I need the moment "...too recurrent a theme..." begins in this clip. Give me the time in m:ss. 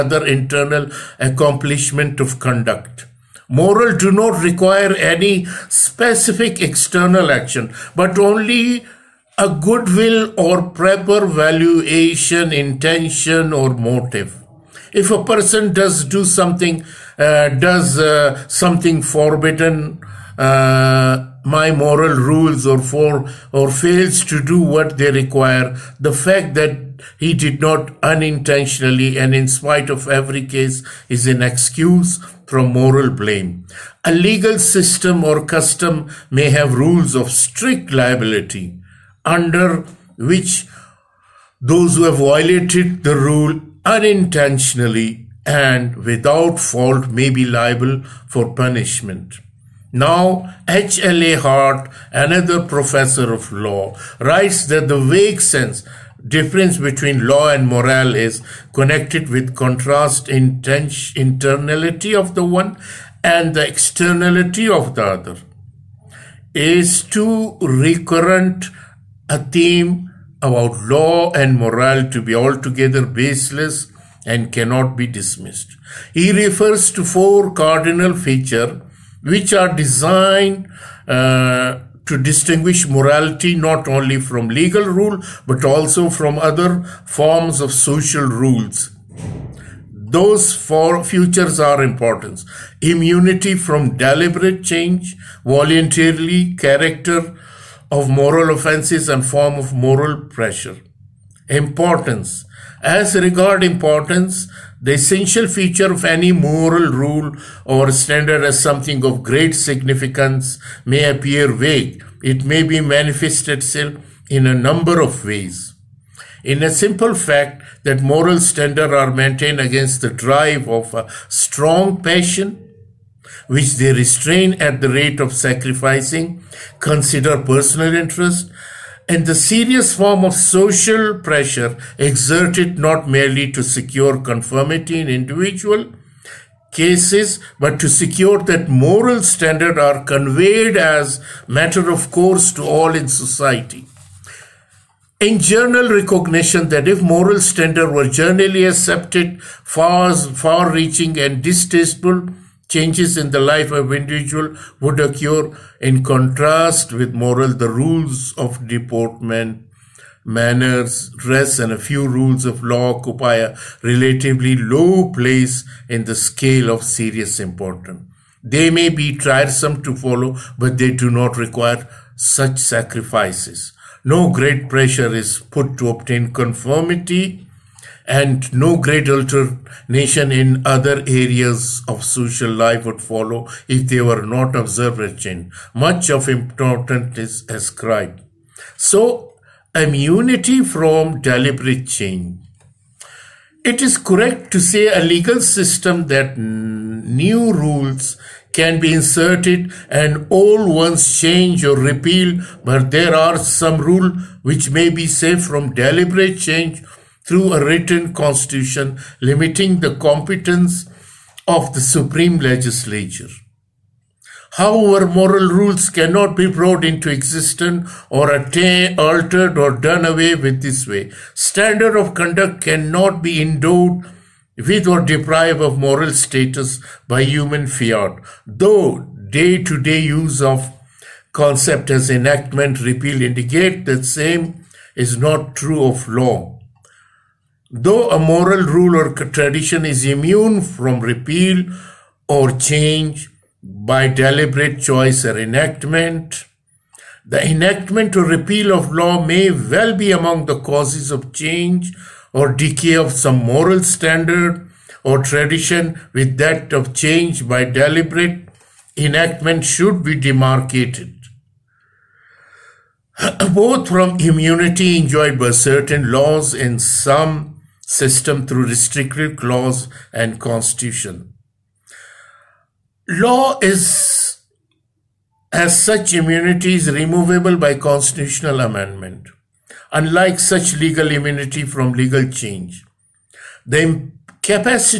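1:07.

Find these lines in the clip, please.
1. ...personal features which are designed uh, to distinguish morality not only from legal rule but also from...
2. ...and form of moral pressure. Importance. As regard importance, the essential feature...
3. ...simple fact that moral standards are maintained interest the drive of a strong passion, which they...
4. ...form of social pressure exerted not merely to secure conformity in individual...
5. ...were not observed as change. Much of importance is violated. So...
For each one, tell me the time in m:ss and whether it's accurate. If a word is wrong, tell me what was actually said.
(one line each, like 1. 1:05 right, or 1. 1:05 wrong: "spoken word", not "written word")
1. 1:17 wrong: "cardinal", not "personal"
2. 1:39 right
3. 1:56 wrong: "against", not "interest"
4. 2:09 right
5. 3:03 wrong: "ascribed", not "violated".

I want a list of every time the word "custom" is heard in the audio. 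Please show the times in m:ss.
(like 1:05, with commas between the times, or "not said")
0:35.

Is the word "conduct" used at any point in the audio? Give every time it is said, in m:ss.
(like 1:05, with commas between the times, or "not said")
0:02, 3:42.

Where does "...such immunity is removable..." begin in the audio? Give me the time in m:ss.
4:35.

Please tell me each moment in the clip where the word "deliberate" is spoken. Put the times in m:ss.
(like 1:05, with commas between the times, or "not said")
1:33, 3:11, 3:25, 4:04, 4:17.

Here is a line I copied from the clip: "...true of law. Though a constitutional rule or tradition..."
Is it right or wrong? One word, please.
wrong.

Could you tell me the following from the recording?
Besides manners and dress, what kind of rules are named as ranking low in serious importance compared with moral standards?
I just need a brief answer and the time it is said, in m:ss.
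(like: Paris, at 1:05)
rules of deportment, at 2:37.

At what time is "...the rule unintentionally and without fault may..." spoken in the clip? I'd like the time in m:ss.
0:43.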